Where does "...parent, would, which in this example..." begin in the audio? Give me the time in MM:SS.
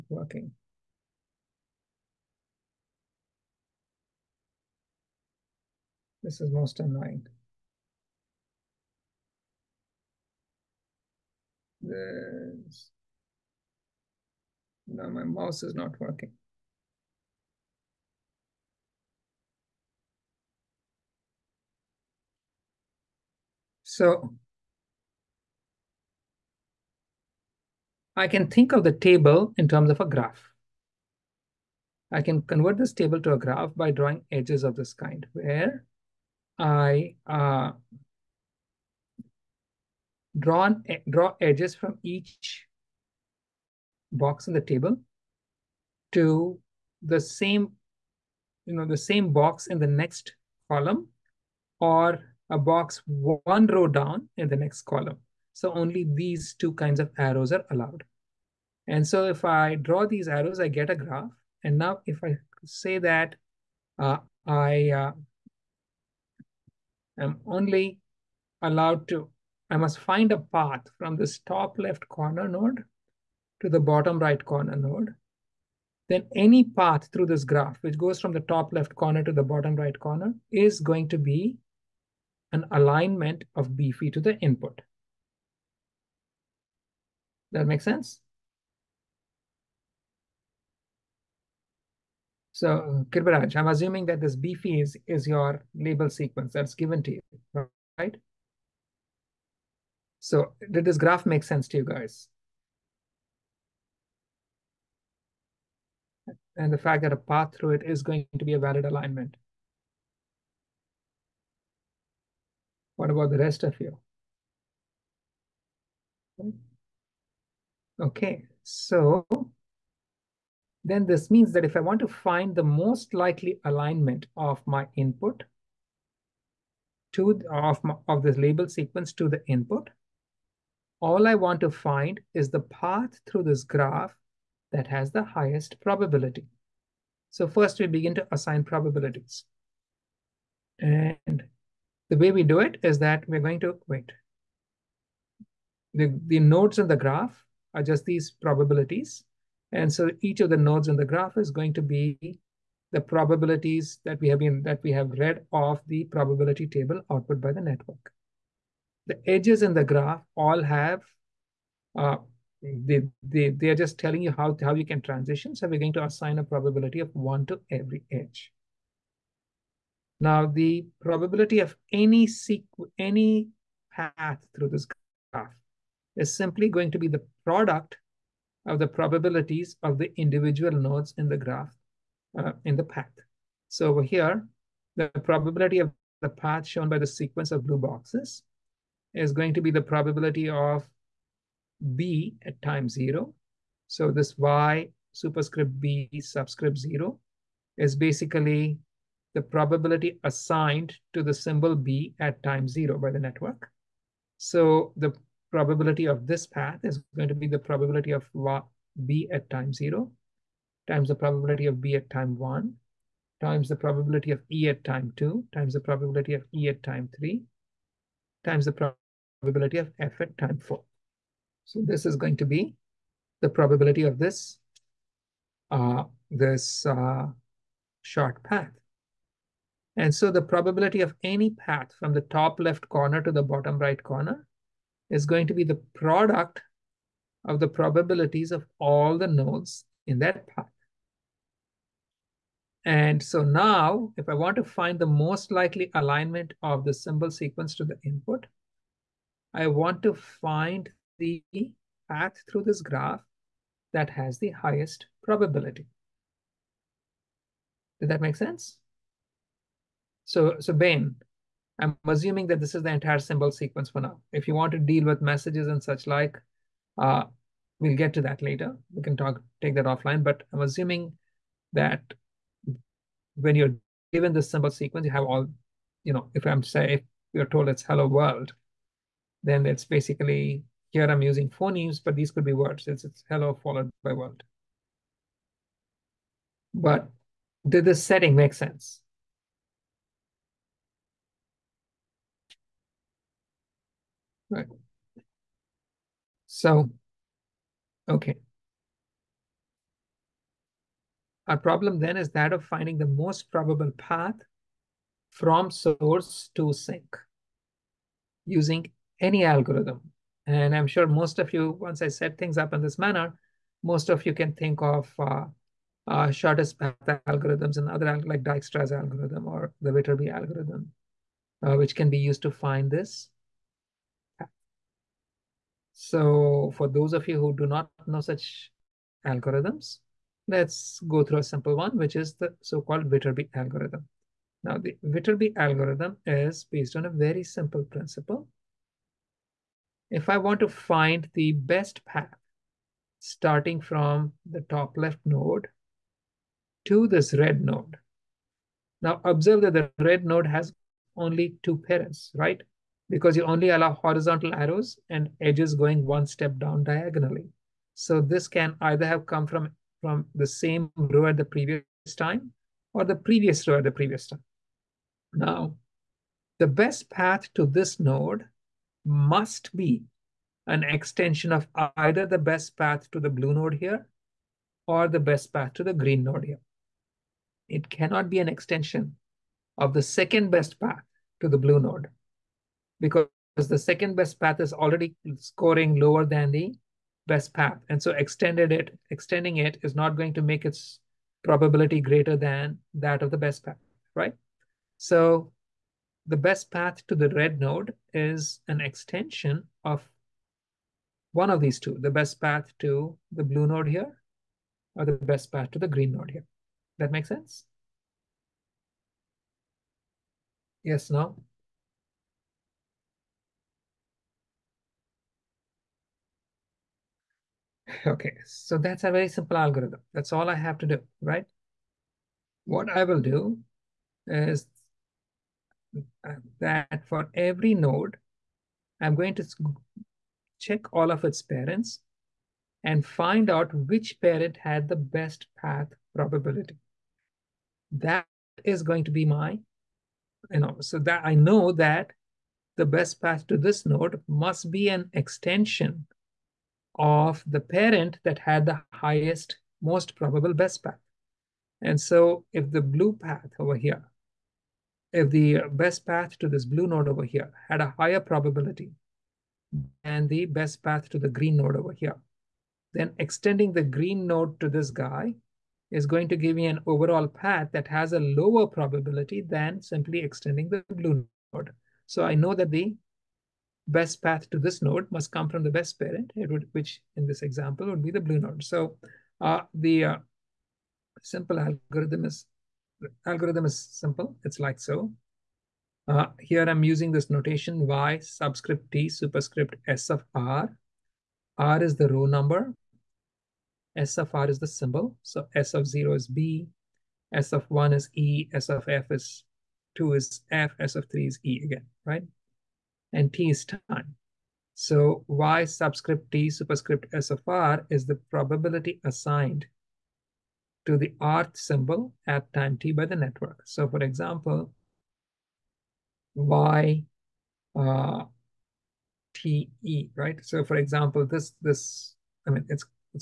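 07:55.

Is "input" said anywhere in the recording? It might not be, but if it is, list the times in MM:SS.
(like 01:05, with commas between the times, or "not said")
01:24, 02:04, 02:09, 04:08.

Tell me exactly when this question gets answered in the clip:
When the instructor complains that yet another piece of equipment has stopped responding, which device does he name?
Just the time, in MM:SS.
00:15.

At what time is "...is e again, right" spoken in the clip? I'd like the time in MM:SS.
08:21.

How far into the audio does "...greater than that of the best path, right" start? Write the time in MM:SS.
06:32.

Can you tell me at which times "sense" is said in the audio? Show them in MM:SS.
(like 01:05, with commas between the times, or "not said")
01:27, 01:41, 04:18, 04:48, 06:47.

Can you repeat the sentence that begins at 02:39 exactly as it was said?
The edges in the graph all have uh, they, they, they are just telling you how, how you can transition.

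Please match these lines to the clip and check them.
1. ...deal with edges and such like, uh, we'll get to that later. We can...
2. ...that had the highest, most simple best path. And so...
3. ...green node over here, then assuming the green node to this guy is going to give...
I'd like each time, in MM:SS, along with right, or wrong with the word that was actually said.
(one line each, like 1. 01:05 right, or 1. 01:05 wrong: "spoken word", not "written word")
1. 04:24 wrong: "messages", not "edges"
2. 07:28 wrong: "probable", not "simple"
3. 07:41 wrong: "extending", not "assuming".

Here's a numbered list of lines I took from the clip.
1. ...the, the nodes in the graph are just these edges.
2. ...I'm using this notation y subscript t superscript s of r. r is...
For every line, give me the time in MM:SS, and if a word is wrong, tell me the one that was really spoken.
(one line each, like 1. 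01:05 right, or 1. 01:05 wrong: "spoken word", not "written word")
1. 02:25 wrong: "probabilities", not "edges"
2. 08:06 right.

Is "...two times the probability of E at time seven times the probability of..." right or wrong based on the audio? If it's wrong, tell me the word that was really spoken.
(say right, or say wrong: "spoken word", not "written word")
wrong: "three", not "seven".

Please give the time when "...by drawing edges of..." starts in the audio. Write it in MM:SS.
00:33.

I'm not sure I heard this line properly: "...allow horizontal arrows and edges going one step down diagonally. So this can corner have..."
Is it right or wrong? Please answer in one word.
wrong.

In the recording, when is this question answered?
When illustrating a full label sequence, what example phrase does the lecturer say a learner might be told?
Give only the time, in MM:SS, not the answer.
04:37.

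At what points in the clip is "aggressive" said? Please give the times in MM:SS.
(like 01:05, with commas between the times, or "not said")
not said.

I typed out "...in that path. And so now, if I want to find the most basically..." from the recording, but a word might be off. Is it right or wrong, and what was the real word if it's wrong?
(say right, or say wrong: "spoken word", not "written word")
wrong: "likely", not "basically".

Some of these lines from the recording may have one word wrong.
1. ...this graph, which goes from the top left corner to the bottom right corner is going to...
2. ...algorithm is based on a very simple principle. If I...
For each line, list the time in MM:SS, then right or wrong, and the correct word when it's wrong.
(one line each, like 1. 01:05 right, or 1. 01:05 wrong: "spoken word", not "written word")
1. 01:17 right
2. 05:35 right.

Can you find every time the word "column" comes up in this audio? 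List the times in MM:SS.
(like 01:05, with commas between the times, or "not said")
00:50, 00:54.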